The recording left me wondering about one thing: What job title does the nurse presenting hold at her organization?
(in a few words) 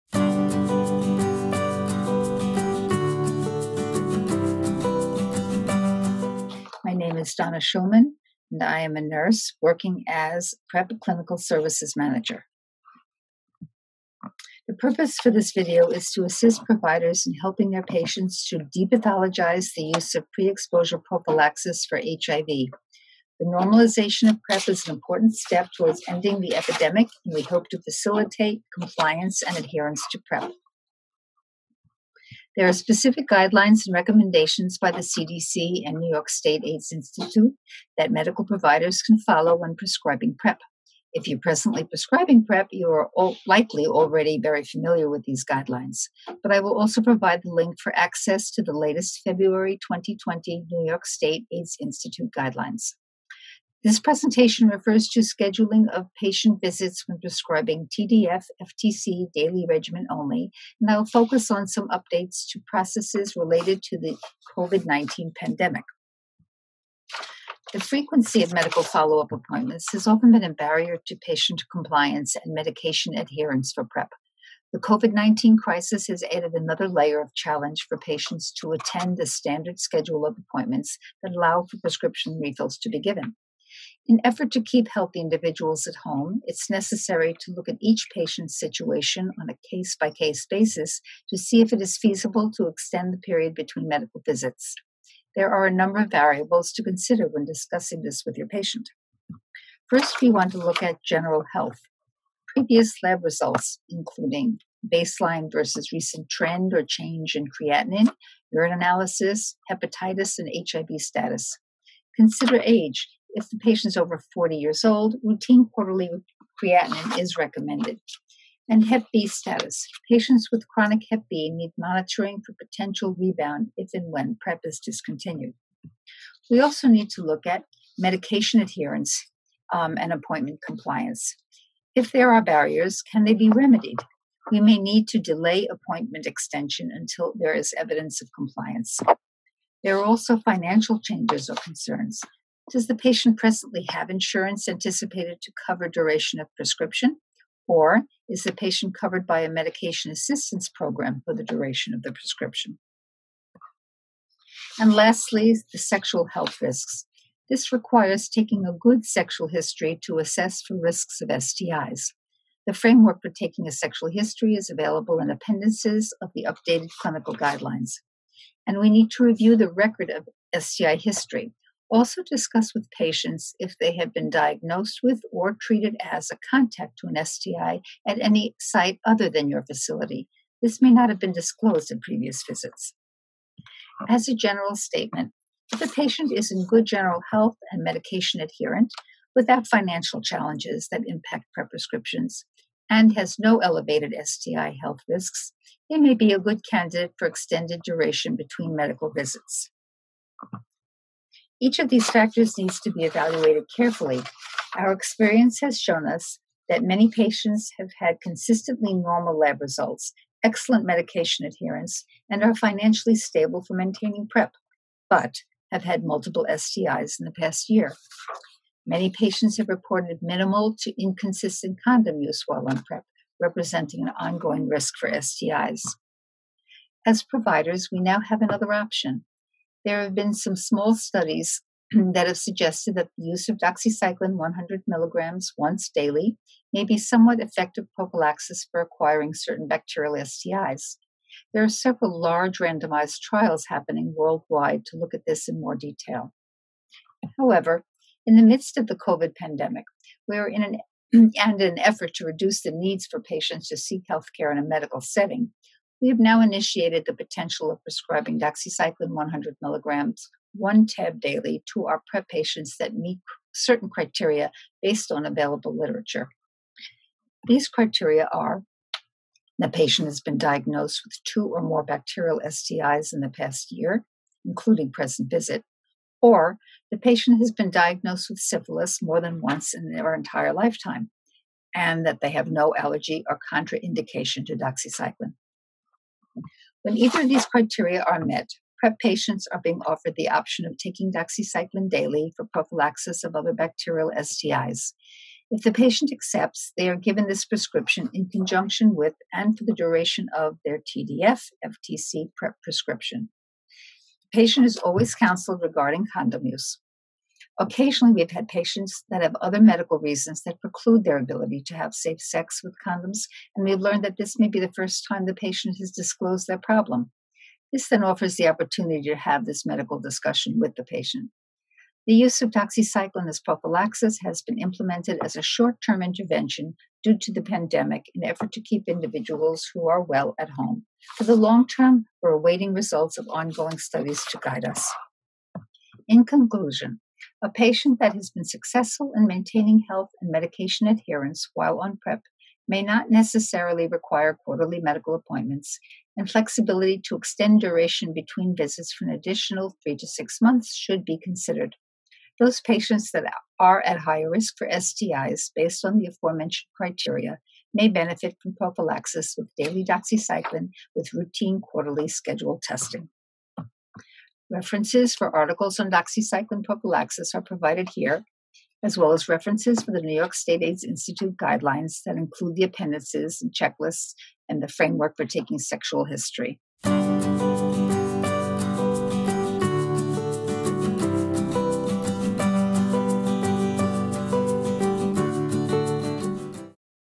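PrEP Clinical Services Manager.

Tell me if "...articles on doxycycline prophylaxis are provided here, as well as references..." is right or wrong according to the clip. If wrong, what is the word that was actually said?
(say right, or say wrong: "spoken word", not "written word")
right.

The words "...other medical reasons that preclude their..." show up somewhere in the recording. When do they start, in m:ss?
5:09.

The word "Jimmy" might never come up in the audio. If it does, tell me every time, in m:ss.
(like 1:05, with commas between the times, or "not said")
not said.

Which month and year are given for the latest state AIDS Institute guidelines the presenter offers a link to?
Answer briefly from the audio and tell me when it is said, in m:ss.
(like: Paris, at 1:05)
February 2020, at 0:49.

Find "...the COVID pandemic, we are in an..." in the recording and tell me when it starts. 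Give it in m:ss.
4:08.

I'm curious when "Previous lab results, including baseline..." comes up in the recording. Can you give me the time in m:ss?
1:42.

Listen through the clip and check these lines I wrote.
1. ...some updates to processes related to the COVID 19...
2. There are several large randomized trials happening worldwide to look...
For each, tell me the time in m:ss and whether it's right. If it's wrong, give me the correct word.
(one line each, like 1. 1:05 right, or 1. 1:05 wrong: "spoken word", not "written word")
1. 1:01 right
2. 4:01 right.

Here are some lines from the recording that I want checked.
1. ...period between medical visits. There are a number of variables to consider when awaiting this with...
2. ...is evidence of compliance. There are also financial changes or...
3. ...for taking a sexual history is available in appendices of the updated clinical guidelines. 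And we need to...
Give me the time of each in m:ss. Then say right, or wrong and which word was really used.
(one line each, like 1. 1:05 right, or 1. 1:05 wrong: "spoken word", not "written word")
1. 1:33 wrong: "discussing", not "awaiting"
2. 2:17 right
3. 2:43 right.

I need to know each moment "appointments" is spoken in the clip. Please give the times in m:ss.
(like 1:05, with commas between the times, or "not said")
1:09, 1:20, 2:10, 2:15, 5:45.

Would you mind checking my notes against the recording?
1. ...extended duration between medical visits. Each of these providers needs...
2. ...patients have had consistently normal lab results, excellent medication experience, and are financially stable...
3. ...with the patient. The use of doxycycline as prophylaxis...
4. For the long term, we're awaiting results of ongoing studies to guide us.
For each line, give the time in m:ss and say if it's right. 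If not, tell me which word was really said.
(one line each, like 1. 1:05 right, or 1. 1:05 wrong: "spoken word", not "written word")
1. 3:17 wrong: "factors", not "providers"
2. 3:27 wrong: "adherence", not "experience"
3. 5:20 right
4. 5:31 right.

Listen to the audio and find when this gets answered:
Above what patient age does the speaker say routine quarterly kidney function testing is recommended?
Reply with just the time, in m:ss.
1:54.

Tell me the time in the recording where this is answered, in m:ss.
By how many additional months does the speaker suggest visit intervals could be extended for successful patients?
5:49.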